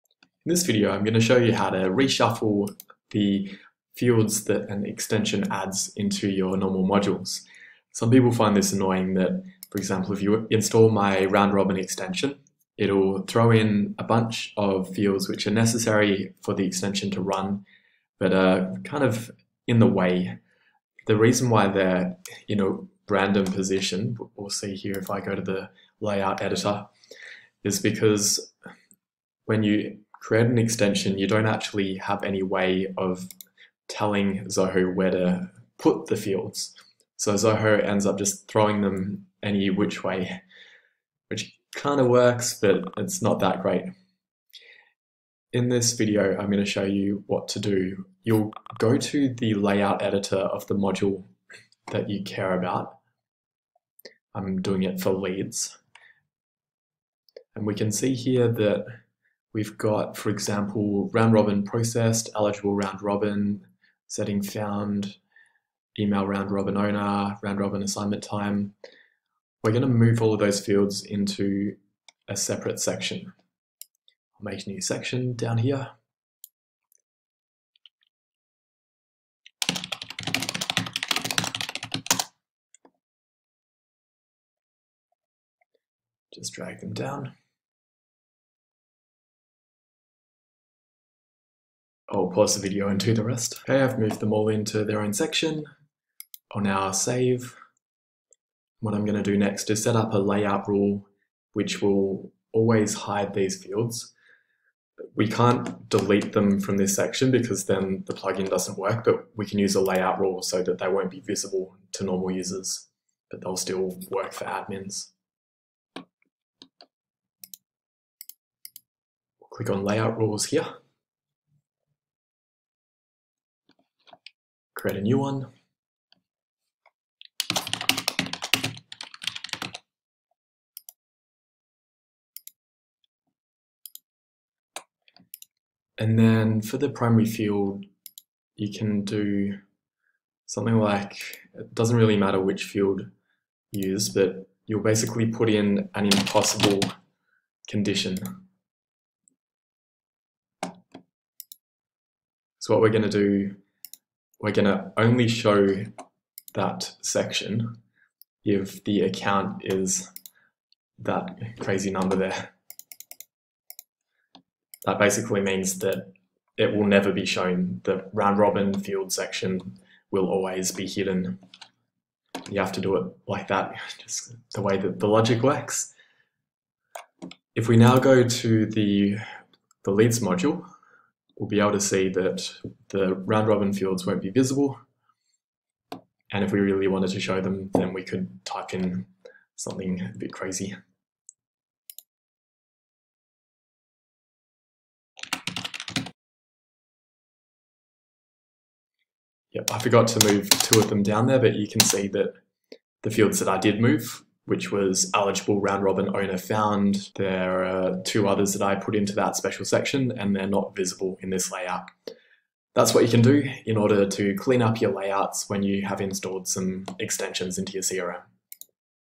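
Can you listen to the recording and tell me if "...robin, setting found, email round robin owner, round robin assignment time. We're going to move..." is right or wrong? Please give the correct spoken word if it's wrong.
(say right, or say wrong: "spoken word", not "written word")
right.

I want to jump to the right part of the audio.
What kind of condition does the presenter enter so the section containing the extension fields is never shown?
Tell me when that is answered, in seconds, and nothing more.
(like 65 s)
146 s.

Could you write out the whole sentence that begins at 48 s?
You'll go to the layout editor of the module that you care about.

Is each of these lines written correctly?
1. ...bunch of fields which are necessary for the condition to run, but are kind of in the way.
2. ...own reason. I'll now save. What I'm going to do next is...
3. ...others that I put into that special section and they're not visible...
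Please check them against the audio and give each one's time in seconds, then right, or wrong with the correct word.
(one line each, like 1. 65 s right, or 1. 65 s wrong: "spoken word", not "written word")
1. 14 s wrong: "extension", not "condition"
2. 95 s wrong: "section", not "reason"
3. 208 s right.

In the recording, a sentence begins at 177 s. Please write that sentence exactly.
If we now go to the, the leads module, we'll be able to see that the round robin fields won't be visible.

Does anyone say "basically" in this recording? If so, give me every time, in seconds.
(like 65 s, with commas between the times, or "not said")
144 s, 164 s.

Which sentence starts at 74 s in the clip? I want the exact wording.
I'll make a new section down here.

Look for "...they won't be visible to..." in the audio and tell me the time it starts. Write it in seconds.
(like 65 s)
110 s.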